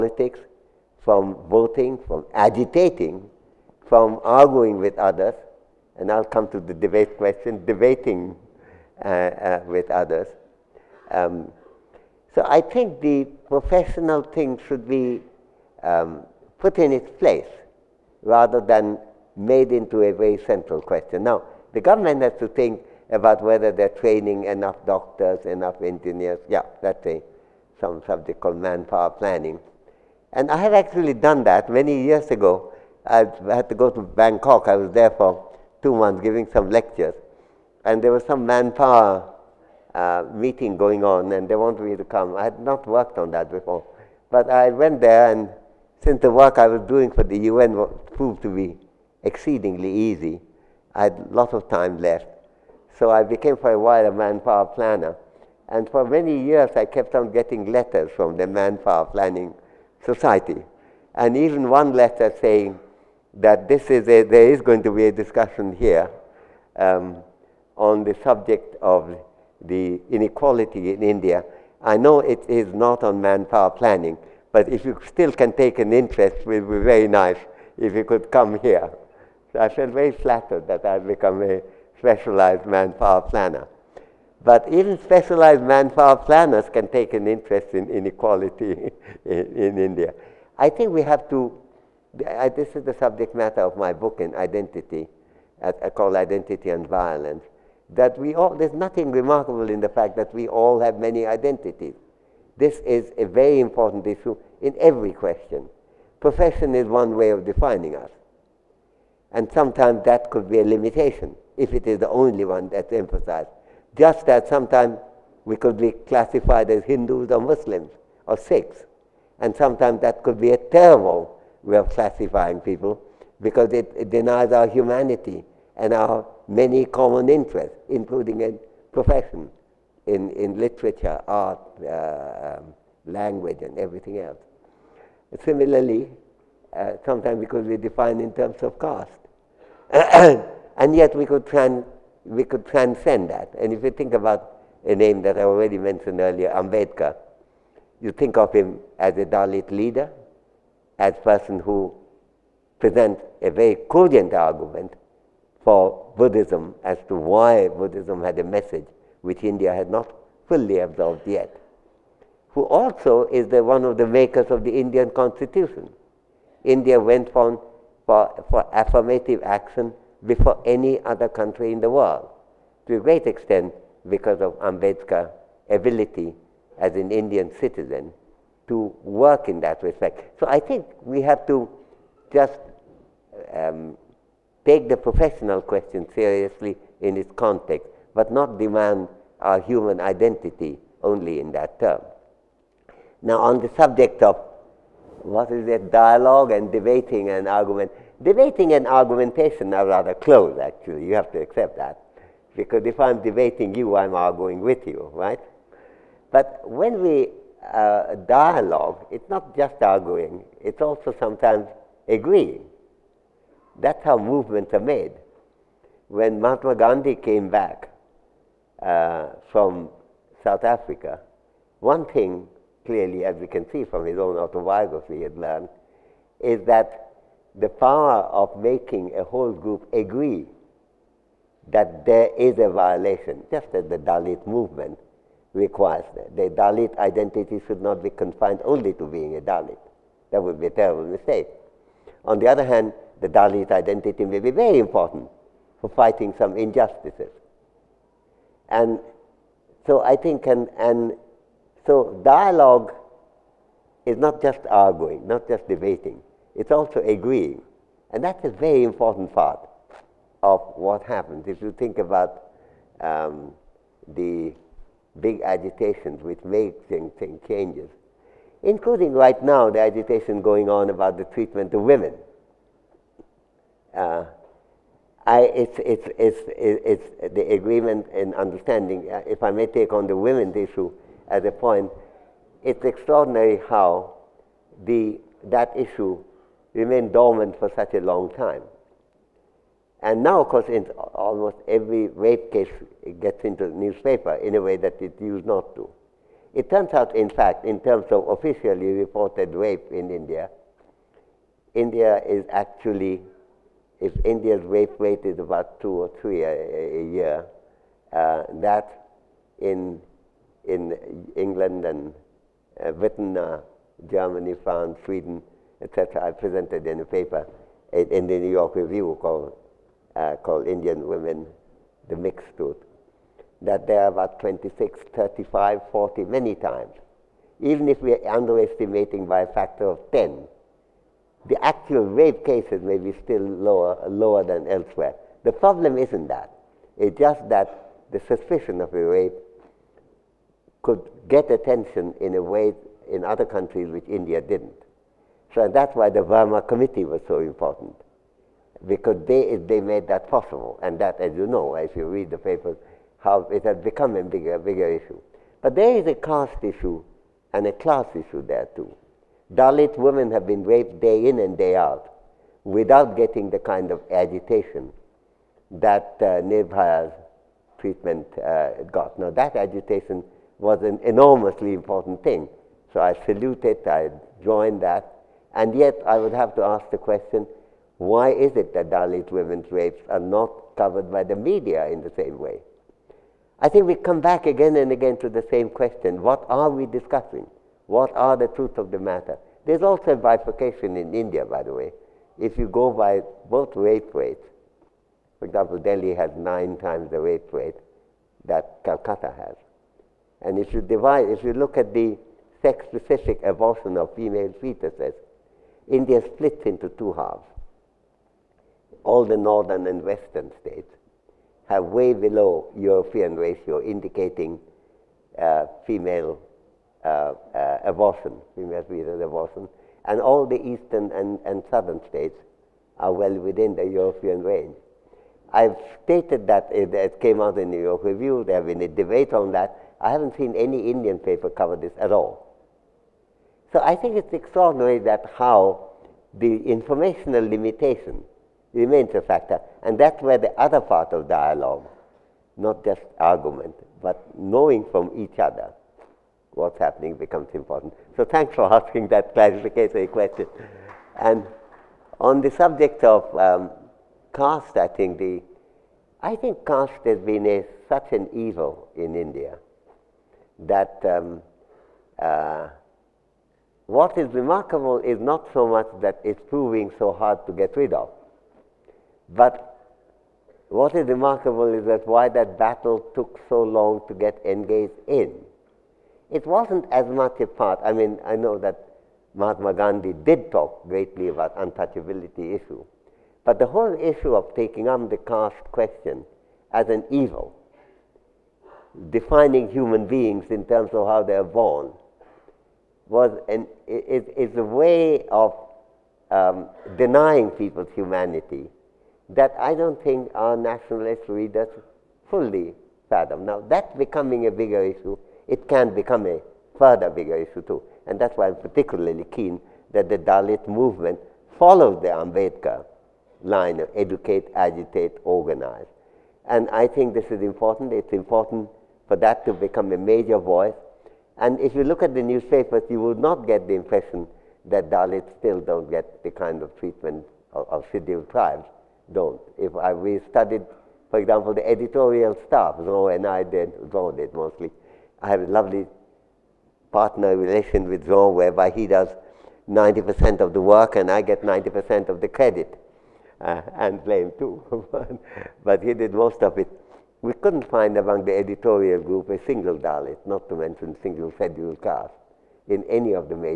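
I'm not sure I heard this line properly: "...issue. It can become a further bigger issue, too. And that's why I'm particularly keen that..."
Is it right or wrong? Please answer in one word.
right.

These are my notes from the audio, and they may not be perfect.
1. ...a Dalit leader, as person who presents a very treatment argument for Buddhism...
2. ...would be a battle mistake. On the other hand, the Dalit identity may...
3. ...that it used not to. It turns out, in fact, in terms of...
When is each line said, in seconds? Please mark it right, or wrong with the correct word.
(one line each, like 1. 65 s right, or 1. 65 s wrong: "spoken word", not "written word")
1. 149 s wrong: "cogent", not "treatment"
2. 240 s wrong: "terrible", not "battle"
3. 294 s right.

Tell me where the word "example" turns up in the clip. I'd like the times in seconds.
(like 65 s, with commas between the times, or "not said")
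395 s, 531 s.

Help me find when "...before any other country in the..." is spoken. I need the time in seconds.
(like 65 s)
170 s.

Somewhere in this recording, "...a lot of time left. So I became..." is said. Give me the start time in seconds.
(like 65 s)
51 s.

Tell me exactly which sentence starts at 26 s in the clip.
Yeah, that's a, some subject called manpower planning.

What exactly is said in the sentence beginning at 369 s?
Now, that agitation was an enormously important thing.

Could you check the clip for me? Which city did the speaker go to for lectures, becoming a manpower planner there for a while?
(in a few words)
Bangkok.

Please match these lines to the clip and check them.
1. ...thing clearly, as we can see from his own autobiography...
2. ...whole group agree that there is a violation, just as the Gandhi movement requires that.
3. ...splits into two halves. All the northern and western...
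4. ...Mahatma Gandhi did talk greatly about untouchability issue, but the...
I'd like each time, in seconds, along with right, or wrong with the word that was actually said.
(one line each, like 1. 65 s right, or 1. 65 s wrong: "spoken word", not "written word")
1. 222 s right
2. 229 s wrong: "Dalit", not "Gandhi"
3. 406 s right
4. 479 s right.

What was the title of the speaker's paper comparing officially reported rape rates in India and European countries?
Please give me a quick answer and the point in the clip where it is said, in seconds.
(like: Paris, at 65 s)
Indian Women, the Mixed Truth, at 320 s.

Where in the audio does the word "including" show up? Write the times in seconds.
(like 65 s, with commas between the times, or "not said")
127 s, 268 s.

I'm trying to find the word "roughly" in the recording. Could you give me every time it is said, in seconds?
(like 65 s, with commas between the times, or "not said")
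not said.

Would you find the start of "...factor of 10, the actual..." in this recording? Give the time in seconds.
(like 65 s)
329 s.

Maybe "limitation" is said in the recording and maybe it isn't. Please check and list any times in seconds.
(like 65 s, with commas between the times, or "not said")
110 s, 437 s.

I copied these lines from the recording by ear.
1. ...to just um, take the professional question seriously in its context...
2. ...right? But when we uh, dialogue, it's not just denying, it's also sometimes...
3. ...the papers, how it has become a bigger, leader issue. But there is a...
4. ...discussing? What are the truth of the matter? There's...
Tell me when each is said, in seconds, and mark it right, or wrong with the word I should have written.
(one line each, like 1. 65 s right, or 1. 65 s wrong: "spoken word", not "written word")
1. 181 s right
2. 205 s wrong: "arguing", not "denying"
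3. 352 s wrong: "bigger", not "leader"
4. 386 s right.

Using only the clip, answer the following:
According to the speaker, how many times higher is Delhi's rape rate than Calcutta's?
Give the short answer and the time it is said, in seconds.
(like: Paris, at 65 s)
9, at 396 s.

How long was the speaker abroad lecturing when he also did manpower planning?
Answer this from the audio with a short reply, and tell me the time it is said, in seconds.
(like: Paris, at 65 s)
two months, at 35 s.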